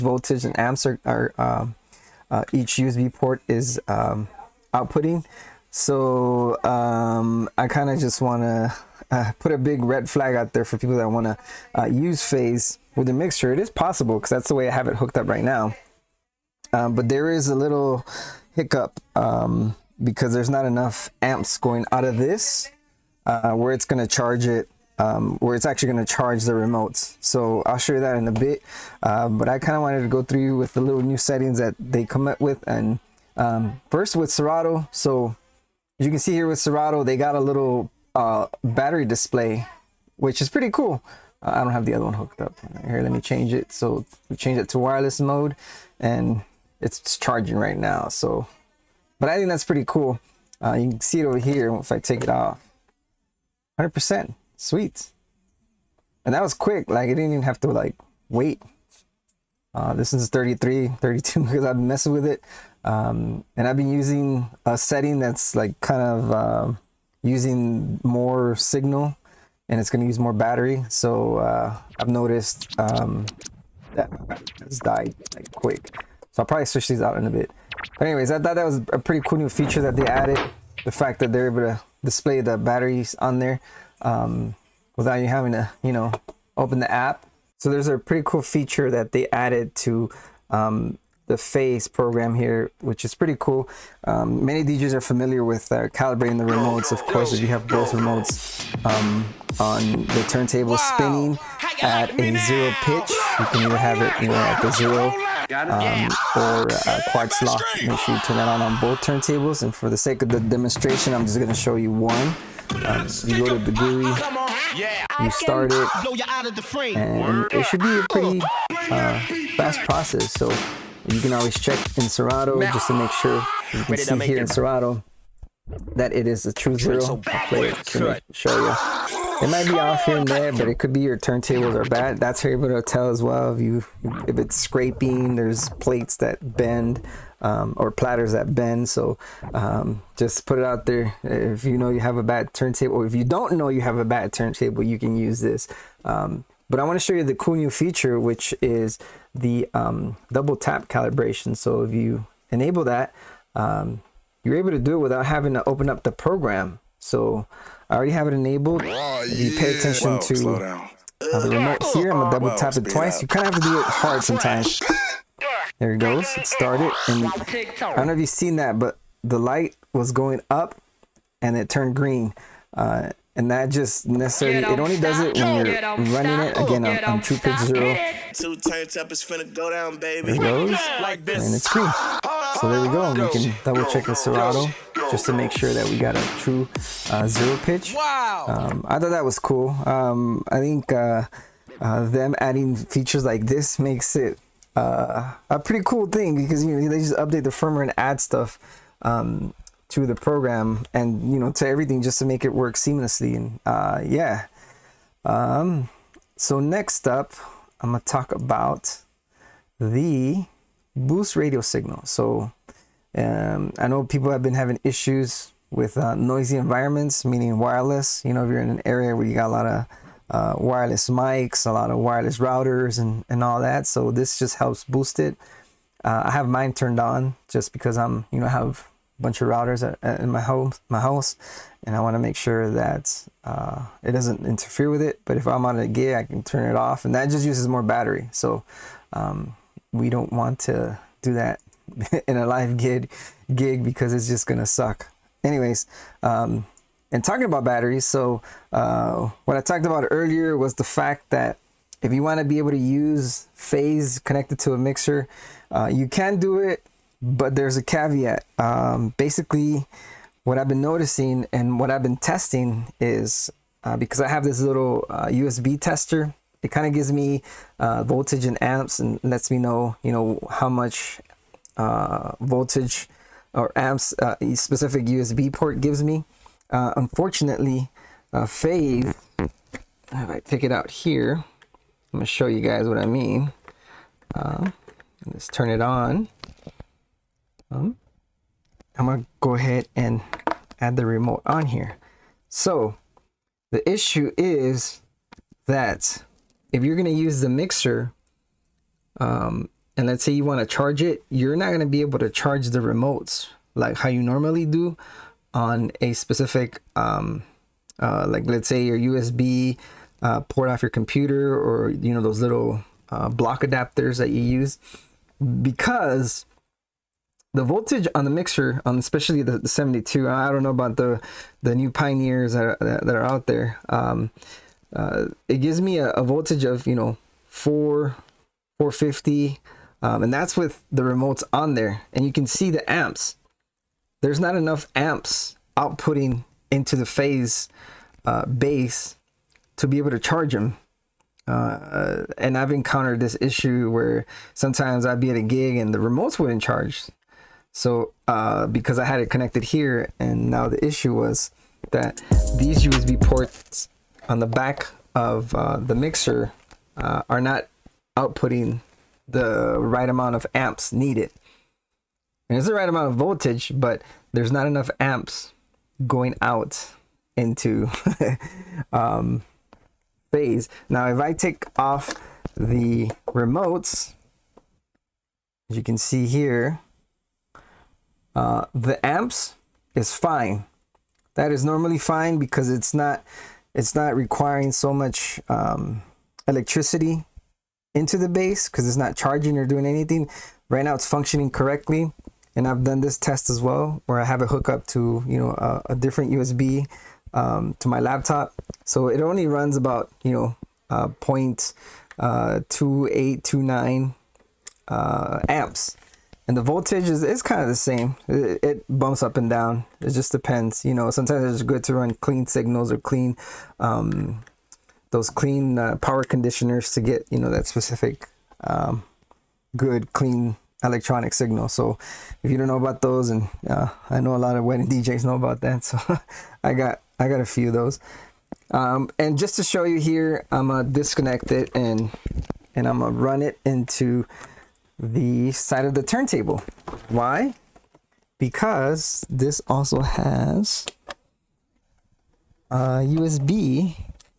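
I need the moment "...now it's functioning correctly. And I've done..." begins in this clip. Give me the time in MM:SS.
06:30.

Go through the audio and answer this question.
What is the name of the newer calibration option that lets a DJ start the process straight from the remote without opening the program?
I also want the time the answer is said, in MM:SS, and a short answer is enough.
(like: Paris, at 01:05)
Double tap calibration, at 02:30.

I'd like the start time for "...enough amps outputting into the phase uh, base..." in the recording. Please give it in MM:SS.
05:34.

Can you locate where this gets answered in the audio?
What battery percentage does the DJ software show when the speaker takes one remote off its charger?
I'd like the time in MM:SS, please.
00:53.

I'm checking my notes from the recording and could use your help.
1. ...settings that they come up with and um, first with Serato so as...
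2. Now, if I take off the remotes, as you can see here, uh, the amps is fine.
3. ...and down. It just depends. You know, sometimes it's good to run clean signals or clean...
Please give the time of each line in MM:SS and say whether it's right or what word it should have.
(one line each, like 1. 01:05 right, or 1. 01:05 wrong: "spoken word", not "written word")
1. 00:31 right
2. 06:10 right
3. 06:49 right.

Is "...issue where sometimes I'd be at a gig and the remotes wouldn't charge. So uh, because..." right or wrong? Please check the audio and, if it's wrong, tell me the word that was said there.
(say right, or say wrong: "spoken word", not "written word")
right.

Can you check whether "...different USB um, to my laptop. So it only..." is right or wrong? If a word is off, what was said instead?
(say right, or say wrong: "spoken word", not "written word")
right.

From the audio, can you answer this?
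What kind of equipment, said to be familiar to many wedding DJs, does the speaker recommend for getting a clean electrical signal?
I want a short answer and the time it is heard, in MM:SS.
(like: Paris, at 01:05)
Power conditioners, at 06:55.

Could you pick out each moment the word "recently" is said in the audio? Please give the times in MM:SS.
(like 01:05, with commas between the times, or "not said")
not said.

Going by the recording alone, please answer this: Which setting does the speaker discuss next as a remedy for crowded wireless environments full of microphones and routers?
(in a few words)
Boost radio signal.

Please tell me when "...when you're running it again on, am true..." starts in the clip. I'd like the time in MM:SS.
02:55.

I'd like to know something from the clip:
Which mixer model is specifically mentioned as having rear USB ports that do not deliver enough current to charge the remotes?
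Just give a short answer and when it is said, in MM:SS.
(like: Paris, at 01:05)
The 72, at 05:19.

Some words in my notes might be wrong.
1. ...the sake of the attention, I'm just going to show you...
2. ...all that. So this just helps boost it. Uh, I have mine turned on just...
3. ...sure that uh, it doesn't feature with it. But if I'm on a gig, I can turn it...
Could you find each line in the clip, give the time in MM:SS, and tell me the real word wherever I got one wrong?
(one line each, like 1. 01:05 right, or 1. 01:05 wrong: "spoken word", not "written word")
1. 01:49 wrong: "demonstration", not "attention"
2. 03:43 right
3. 03:52 wrong: "interfere", not "feature".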